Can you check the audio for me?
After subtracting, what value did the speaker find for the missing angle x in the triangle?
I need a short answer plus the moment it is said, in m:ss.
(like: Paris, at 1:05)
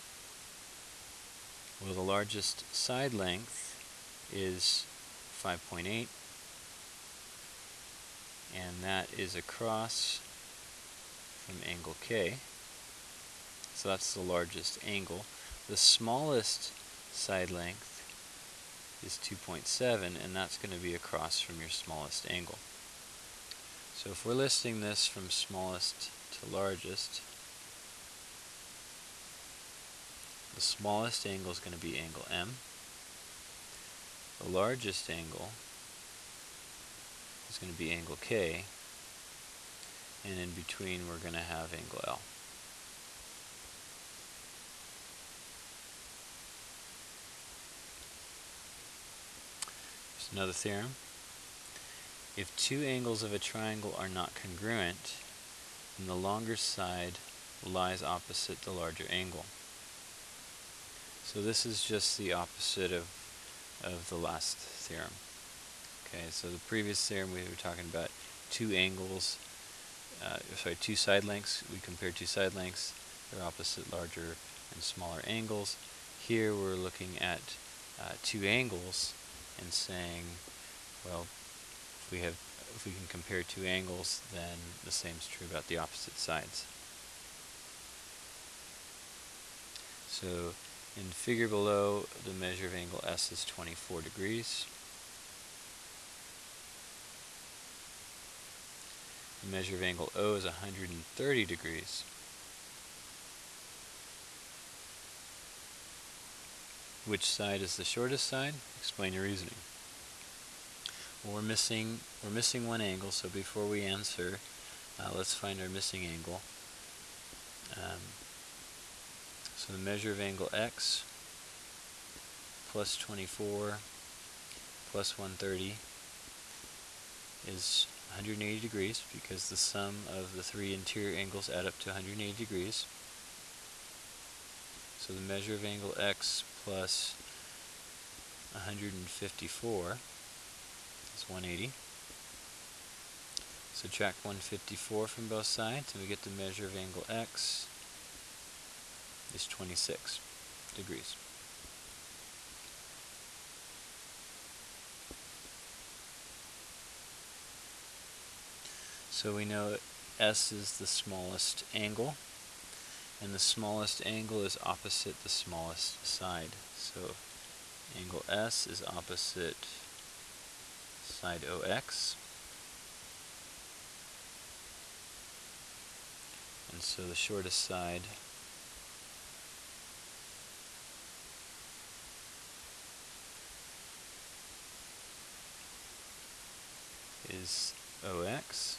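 26 degrees, at 2:29.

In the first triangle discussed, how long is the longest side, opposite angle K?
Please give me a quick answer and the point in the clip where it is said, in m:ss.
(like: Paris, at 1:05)
5.8, at 0:05.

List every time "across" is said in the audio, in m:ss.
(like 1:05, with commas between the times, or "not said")
0:09, 0:20.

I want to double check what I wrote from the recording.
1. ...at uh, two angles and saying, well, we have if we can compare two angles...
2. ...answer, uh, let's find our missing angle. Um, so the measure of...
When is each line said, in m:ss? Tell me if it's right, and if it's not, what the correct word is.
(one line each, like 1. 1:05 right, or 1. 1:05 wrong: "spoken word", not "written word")
1. 1:17 right
2. 1:53 right.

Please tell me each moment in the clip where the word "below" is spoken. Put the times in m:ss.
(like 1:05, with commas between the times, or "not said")
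1:31.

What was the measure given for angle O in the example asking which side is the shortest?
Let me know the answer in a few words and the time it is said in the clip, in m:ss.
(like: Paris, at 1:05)
130 degrees, at 1:40.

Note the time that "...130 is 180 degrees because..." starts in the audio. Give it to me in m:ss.
2:05.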